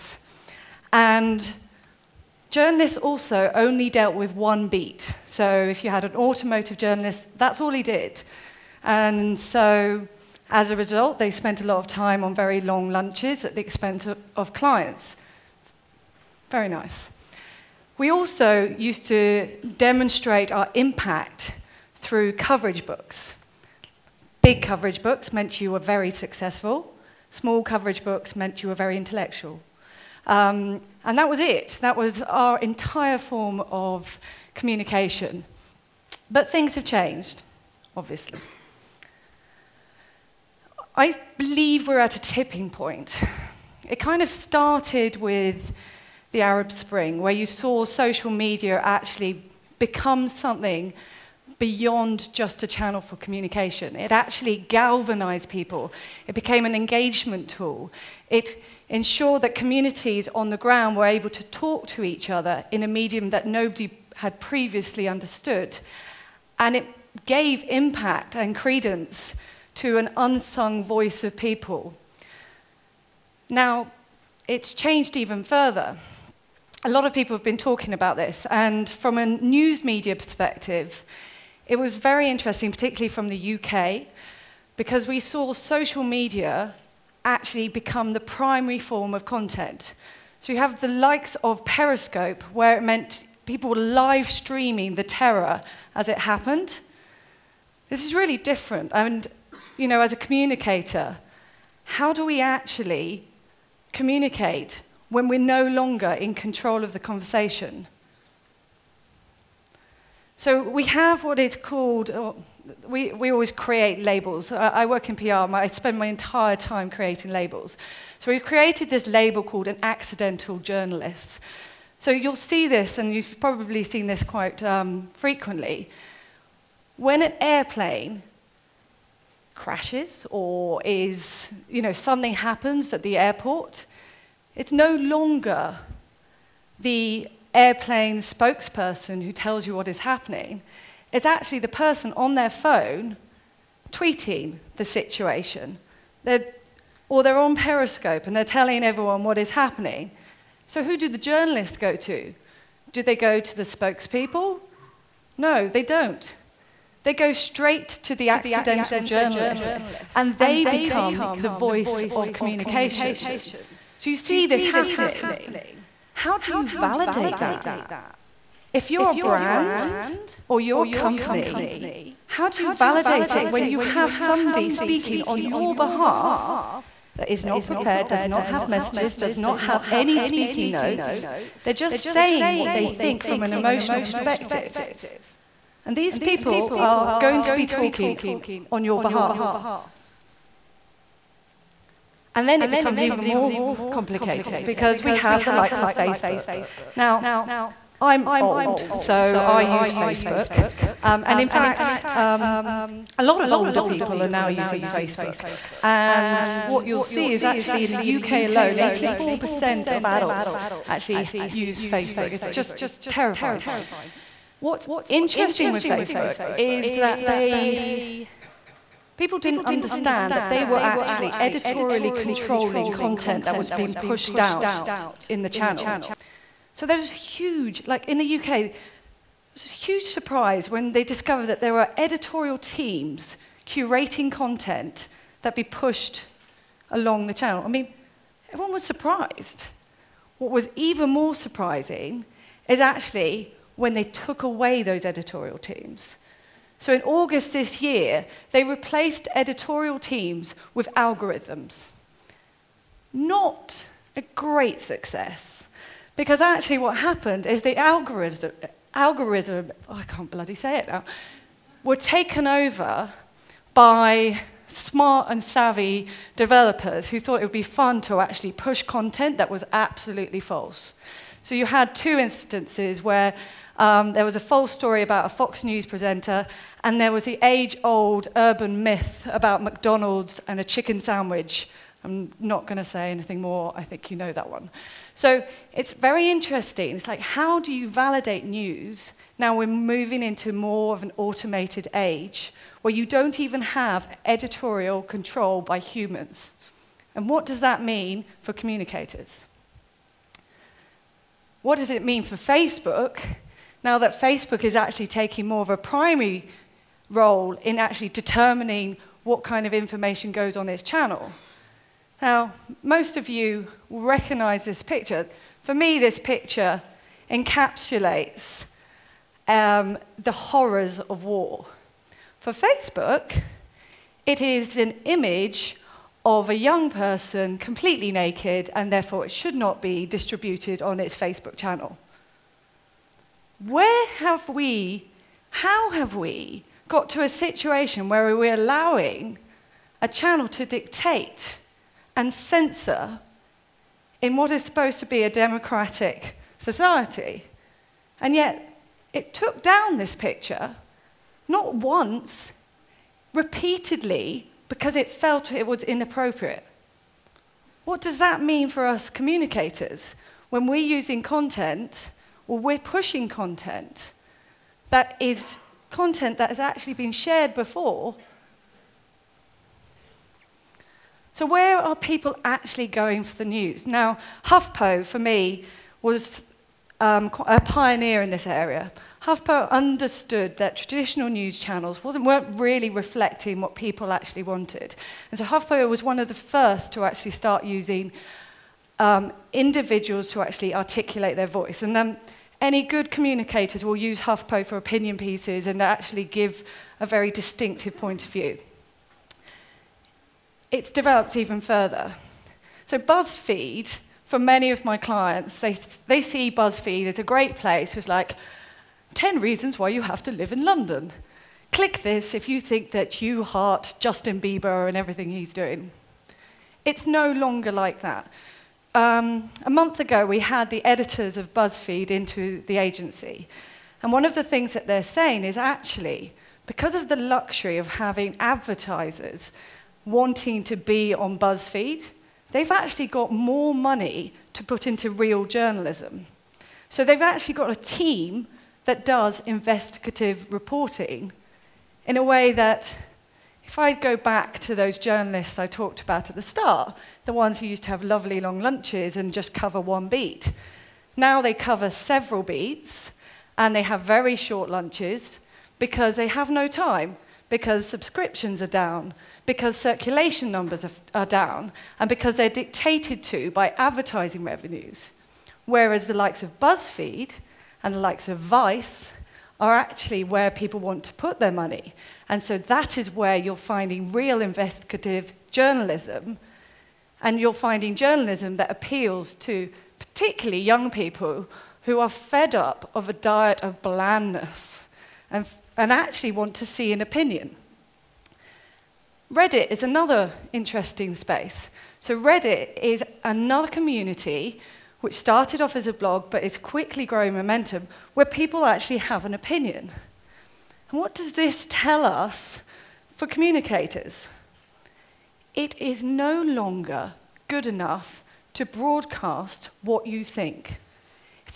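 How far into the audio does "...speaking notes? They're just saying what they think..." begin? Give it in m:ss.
3:00.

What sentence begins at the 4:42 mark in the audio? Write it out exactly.
I'm not going to say anything more.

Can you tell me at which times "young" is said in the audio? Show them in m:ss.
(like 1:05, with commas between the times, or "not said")
5:26, 8:00.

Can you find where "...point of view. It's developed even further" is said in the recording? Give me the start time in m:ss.
6:37.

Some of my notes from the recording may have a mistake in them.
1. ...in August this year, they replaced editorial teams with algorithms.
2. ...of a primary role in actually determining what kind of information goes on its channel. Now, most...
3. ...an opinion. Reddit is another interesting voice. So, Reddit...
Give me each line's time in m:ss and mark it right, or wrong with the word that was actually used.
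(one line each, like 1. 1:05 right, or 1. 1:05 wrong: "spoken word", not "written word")
1. 4:06 right
2. 5:05 right
3. 8:06 wrong: "space", not "voice".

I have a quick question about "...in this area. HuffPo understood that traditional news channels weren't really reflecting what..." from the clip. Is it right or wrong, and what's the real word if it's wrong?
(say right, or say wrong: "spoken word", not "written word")
right.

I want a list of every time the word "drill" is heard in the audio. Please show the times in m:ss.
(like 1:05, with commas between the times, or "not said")
not said.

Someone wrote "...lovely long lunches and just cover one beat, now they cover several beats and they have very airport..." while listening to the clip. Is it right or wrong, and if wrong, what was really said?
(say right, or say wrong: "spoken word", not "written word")
wrong: "short", not "airport".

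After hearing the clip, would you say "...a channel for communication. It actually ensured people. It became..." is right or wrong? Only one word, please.
wrong.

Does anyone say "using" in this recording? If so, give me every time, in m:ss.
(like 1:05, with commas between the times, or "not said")
3:24, 6:00, 6:27.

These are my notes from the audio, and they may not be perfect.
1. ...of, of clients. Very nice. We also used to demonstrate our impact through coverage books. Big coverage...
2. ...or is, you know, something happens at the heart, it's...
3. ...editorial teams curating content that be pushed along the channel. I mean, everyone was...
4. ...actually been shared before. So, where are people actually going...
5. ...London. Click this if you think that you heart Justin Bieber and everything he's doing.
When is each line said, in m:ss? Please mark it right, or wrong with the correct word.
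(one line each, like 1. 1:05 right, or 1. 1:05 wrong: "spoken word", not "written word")
1. 0:14 right
2. 2:10 wrong: "airport", not "heart"
3. 3:51 right
4. 6:06 right
5. 6:50 right.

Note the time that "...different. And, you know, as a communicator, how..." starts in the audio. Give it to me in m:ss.
1:38.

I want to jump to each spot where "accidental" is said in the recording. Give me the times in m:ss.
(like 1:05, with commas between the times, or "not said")
1:59, 2:38.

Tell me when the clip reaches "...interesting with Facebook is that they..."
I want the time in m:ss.
3:35.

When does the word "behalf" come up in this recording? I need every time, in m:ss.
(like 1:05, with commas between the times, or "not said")
2:55, 3:09.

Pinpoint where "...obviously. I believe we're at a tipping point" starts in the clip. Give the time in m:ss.
0:37.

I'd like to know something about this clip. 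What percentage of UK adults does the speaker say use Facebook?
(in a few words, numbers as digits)
84%.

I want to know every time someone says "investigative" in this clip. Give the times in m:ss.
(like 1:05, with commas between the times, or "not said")
7:19, 7:54.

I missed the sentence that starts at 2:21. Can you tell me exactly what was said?
It's actually the person on their phone tweeting the situation.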